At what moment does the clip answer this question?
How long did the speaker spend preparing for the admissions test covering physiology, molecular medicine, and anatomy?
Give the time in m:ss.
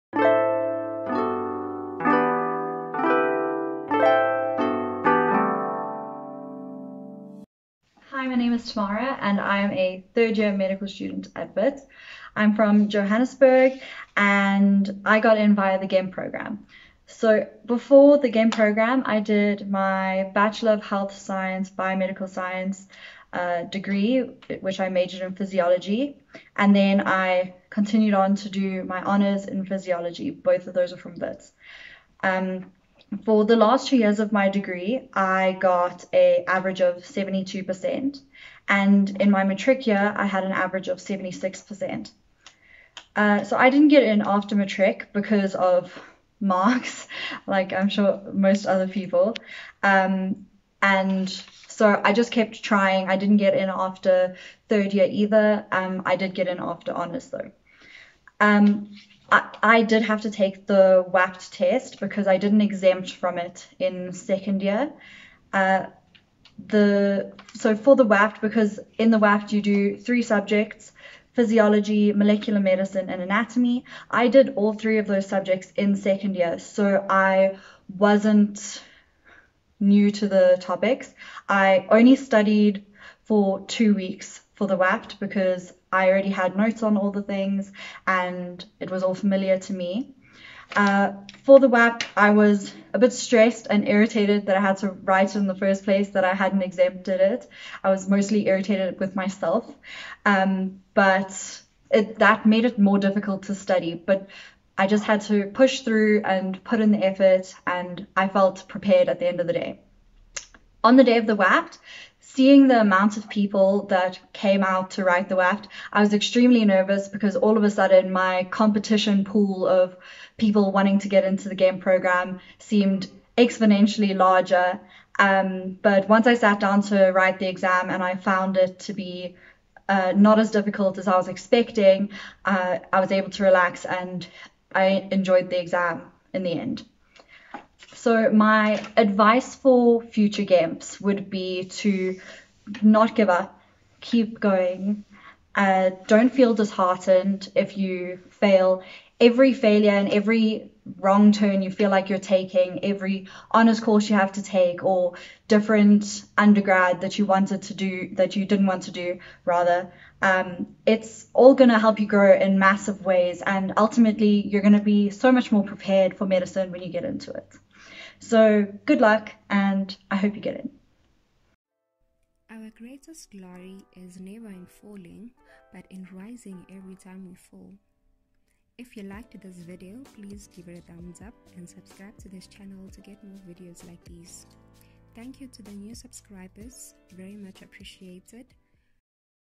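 1:23.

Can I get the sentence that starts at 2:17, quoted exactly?
So, my advice for future GAMS would be to not give up, keep going, uh, don't feel disheartened if you fail.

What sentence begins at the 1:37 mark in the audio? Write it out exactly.
I was mostly irritated with myself, um, but it, that made it more difficult to study.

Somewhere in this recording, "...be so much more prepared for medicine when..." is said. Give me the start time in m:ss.
2:44.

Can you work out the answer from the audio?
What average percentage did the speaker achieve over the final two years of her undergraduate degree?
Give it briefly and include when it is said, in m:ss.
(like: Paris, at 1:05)
72%, at 0:36.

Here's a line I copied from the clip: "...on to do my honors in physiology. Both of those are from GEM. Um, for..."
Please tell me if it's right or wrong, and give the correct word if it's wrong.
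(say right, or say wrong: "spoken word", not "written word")
wrong: "Wits", not "GEM".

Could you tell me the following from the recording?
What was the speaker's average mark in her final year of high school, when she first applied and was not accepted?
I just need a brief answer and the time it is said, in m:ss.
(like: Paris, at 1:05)
76%, at 0:40.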